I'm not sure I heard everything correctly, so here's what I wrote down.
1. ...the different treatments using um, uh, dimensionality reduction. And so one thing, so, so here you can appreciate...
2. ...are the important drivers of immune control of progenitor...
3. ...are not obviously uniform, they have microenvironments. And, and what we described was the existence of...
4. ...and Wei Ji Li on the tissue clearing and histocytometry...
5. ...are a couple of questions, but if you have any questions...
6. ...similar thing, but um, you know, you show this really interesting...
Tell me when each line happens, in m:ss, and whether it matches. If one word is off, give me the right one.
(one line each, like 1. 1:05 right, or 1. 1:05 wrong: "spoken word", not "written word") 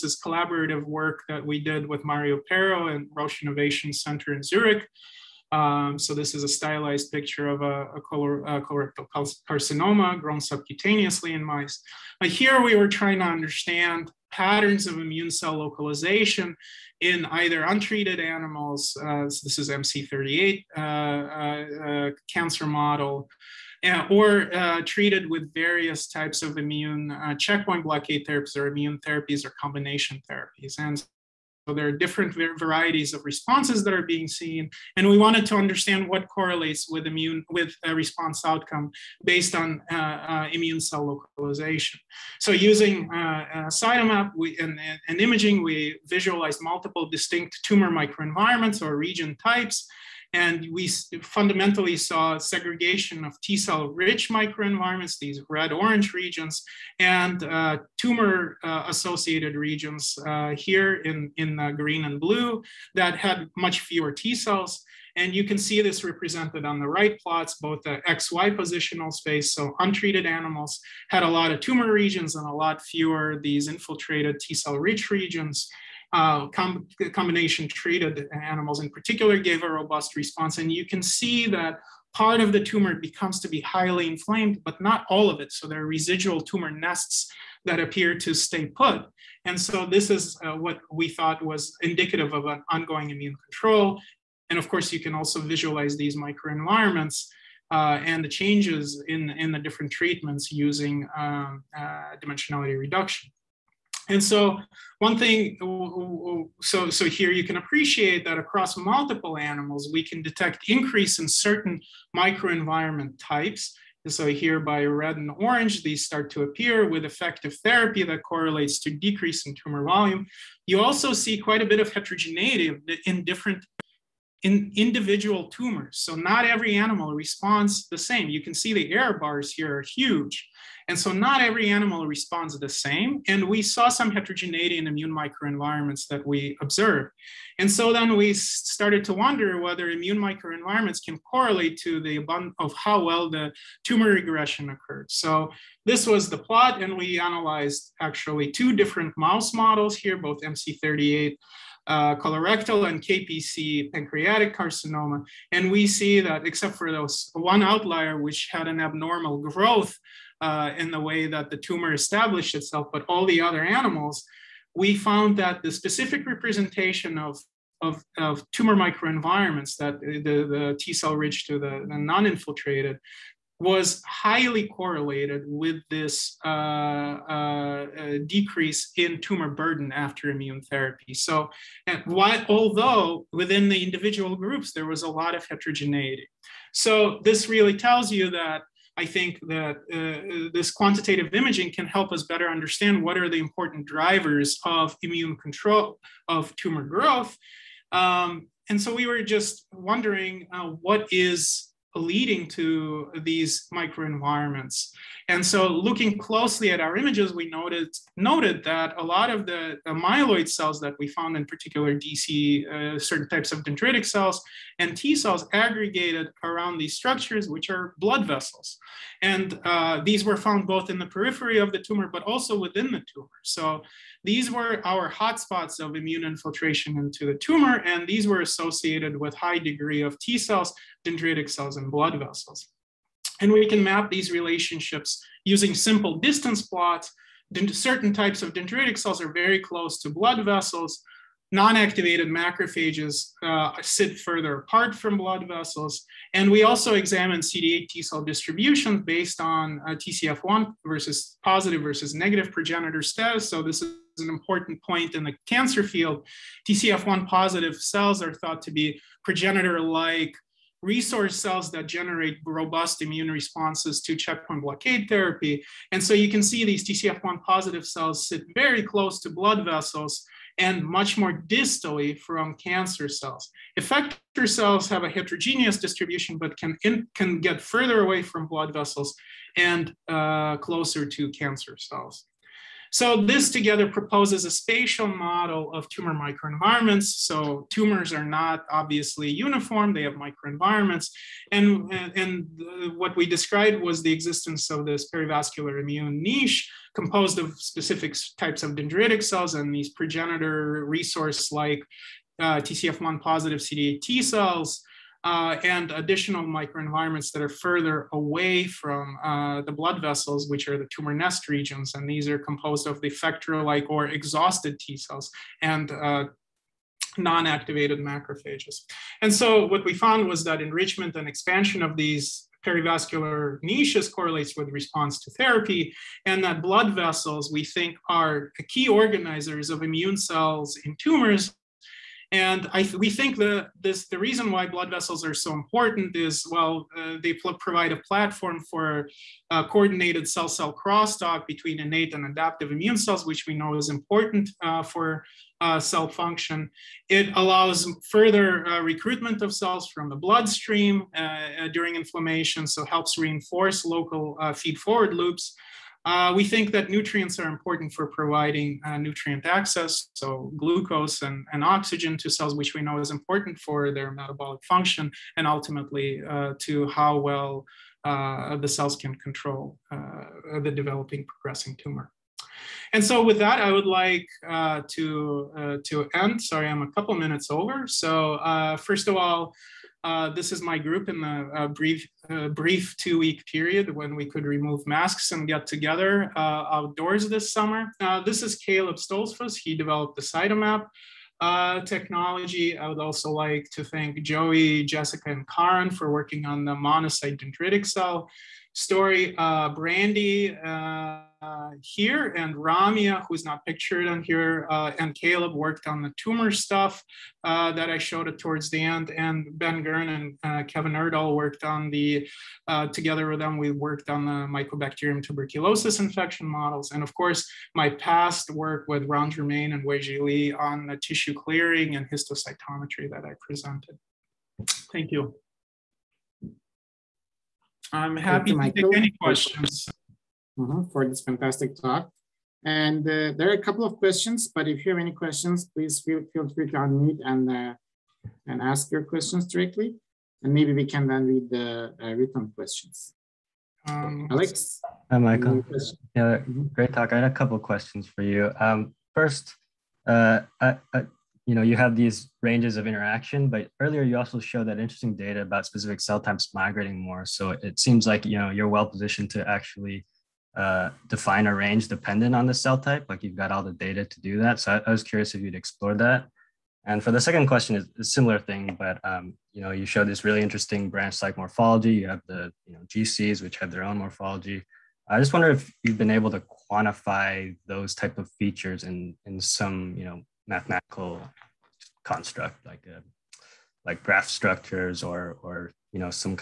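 1. 1:39 right
2. 3:13 wrong: "tumor", not "progenitor"
3. 4:48 right
4. 6:59 right
5. 7:13 right
6. 7:48 right.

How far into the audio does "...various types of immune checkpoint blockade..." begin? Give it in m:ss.
0:25.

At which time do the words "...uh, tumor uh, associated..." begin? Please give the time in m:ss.
0:57.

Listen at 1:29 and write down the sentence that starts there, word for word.
And so this is uh, what we thought was indicative of an ongoing immune control.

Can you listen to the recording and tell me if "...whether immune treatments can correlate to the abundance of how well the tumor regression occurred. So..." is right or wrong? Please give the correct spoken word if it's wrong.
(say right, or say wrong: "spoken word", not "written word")
wrong: "microenvironments", not "treatments".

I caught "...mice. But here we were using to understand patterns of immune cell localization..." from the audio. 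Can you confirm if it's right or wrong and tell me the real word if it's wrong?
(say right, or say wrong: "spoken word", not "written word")
wrong: "trying", not "using".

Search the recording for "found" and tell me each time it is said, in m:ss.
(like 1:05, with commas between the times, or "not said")
2:44, 3:31, 3:40, 5:19.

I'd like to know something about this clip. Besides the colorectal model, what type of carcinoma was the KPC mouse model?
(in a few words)
Pancreatic carcinoma.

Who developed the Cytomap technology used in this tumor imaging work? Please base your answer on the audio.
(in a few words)
Caleb Stolzfus.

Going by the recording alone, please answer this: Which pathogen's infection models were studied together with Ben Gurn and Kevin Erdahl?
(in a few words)
Mycobacterium tuberculosis.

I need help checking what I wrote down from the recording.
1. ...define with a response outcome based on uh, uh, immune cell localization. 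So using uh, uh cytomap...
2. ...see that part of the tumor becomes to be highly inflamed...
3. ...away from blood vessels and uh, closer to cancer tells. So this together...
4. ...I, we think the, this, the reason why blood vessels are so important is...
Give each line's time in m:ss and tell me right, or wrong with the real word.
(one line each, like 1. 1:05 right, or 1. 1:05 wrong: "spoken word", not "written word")
1. 0:37 wrong: "immune", not "define"
2. 1:21 right
3. 4:38 wrong: "cells", not "tells"
4. 5:32 right.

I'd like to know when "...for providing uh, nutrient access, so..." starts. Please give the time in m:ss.
5:57.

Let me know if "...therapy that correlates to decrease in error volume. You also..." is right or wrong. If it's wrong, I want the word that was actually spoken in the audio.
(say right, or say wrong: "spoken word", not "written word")
wrong: "tumor", not "error".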